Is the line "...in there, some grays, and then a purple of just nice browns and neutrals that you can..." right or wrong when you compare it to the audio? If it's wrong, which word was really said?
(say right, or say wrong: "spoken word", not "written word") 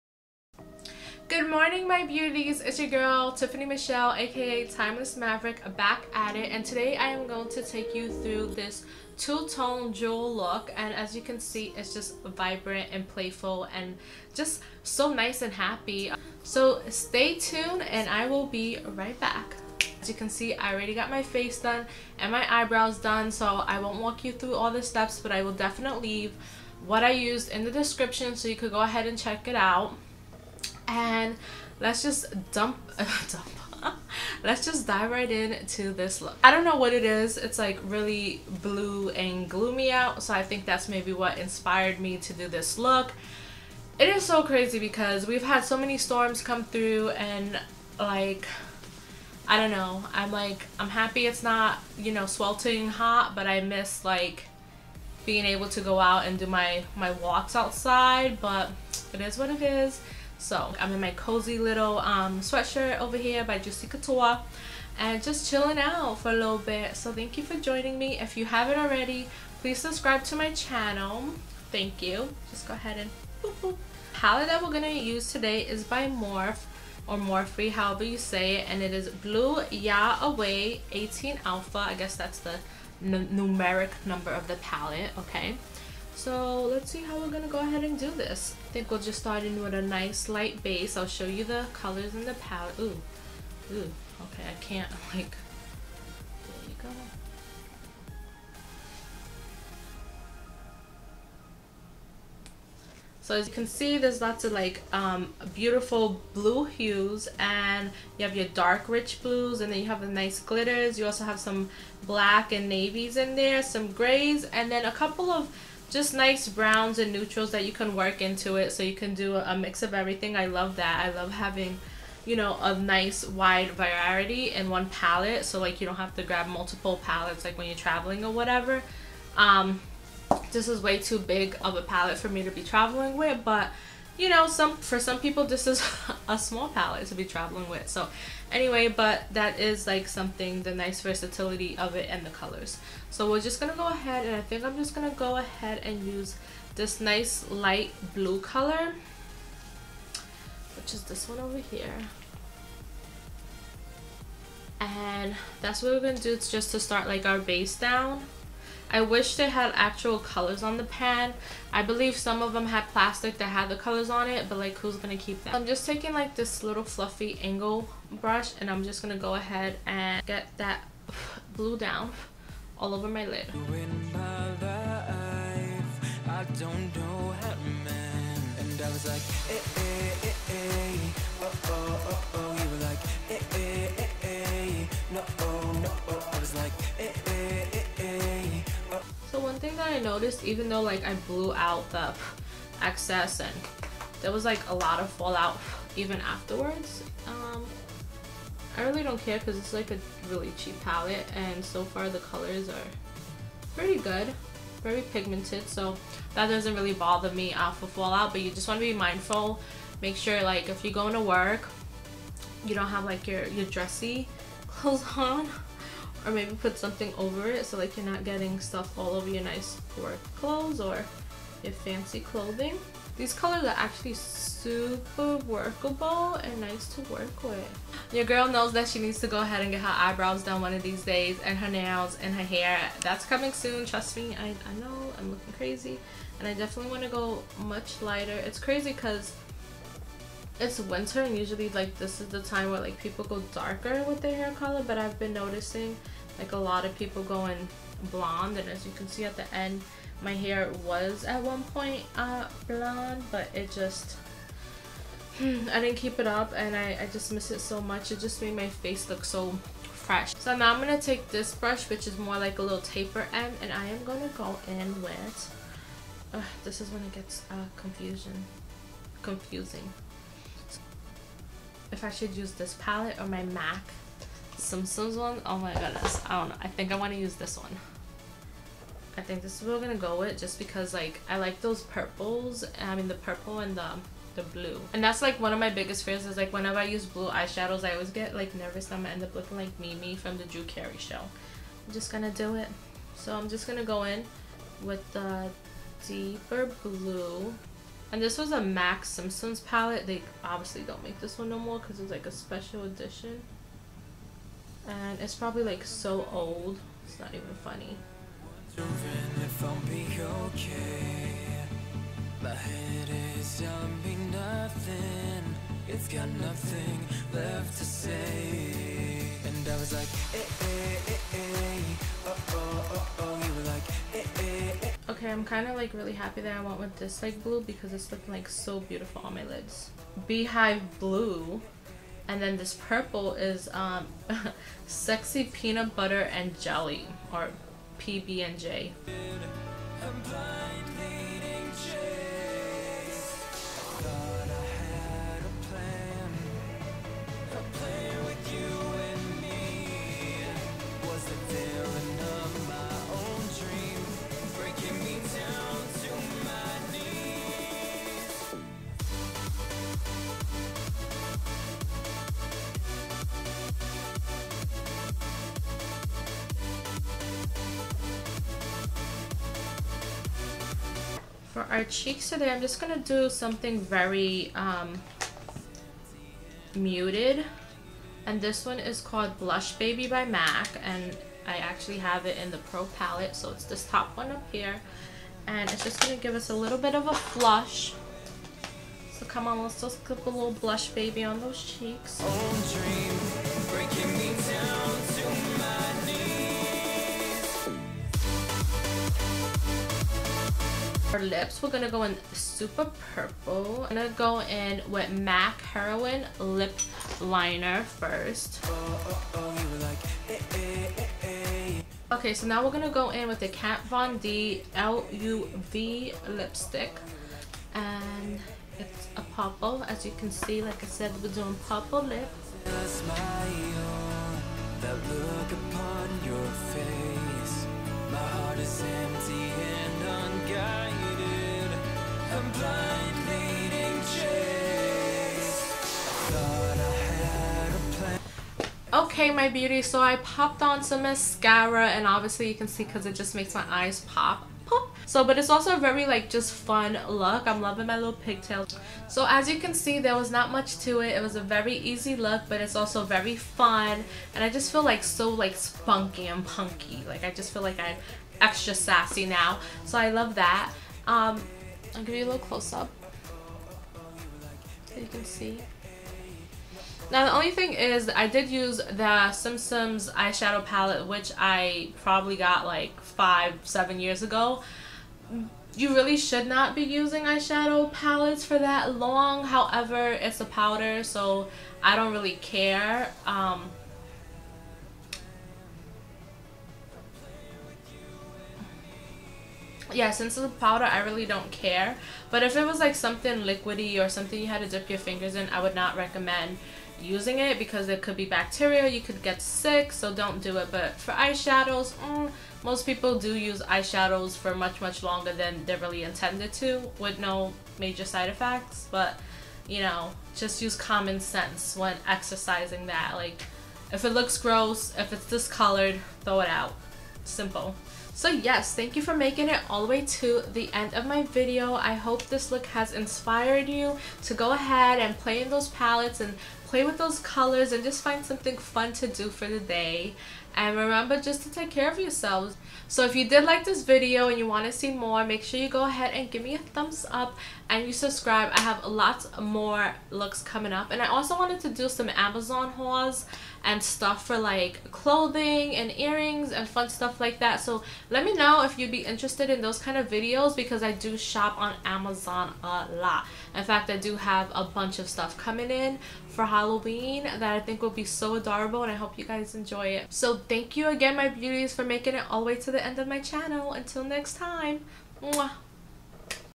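wrong: "couple", not "purple".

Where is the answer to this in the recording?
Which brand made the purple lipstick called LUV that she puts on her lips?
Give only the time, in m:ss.
6:53.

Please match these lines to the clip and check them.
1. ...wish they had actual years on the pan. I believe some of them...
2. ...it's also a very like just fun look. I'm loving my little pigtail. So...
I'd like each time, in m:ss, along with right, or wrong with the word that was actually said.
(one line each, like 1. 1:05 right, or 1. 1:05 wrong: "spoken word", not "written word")
1. 2:38 wrong: "colors", not "years"
2. 7:25 right.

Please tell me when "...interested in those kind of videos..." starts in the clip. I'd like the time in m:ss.
9:09.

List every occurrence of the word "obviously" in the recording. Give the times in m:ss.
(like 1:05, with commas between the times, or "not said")
5:00, 7:22.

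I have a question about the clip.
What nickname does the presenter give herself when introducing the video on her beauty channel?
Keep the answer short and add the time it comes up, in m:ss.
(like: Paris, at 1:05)
Timeless Maverick, at 0:04.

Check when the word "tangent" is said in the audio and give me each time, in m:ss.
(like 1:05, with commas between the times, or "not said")
not said.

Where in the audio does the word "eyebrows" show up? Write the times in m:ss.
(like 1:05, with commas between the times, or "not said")
0:22, 3:50.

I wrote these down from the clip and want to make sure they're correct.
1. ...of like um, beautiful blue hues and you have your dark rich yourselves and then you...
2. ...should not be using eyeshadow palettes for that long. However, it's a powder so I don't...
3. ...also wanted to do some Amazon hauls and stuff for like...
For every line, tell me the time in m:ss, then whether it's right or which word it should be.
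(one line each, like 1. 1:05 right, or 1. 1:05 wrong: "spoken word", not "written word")
1. 1:44 wrong: "blues", not "yourselves"
2. 7:56 right
3. 9:01 right.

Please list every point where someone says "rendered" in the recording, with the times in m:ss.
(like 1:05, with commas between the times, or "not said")
not said.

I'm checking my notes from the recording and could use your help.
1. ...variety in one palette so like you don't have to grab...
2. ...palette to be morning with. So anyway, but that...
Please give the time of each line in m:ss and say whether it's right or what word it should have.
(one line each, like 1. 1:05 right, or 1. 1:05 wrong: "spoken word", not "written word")
1. 2:03 right
2. 2:16 wrong: "traveling", not "morning".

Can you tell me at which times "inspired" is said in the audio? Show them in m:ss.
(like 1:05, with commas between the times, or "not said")
0:41, 8:42.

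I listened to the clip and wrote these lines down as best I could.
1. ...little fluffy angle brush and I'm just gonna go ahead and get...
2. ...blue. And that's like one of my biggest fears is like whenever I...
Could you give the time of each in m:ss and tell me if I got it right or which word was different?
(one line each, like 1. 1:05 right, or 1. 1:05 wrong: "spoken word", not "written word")
1. 2:46 right
2. 4:44 right.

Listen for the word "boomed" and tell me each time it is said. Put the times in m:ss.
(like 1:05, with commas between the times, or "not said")
not said.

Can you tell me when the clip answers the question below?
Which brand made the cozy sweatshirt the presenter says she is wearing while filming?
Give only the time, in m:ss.
1:03.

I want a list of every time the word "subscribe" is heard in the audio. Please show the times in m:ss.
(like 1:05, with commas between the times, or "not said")
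1:09, 8:57.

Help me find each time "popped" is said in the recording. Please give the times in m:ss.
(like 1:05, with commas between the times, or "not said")
7:20.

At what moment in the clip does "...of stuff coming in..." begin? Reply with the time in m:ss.
9:14.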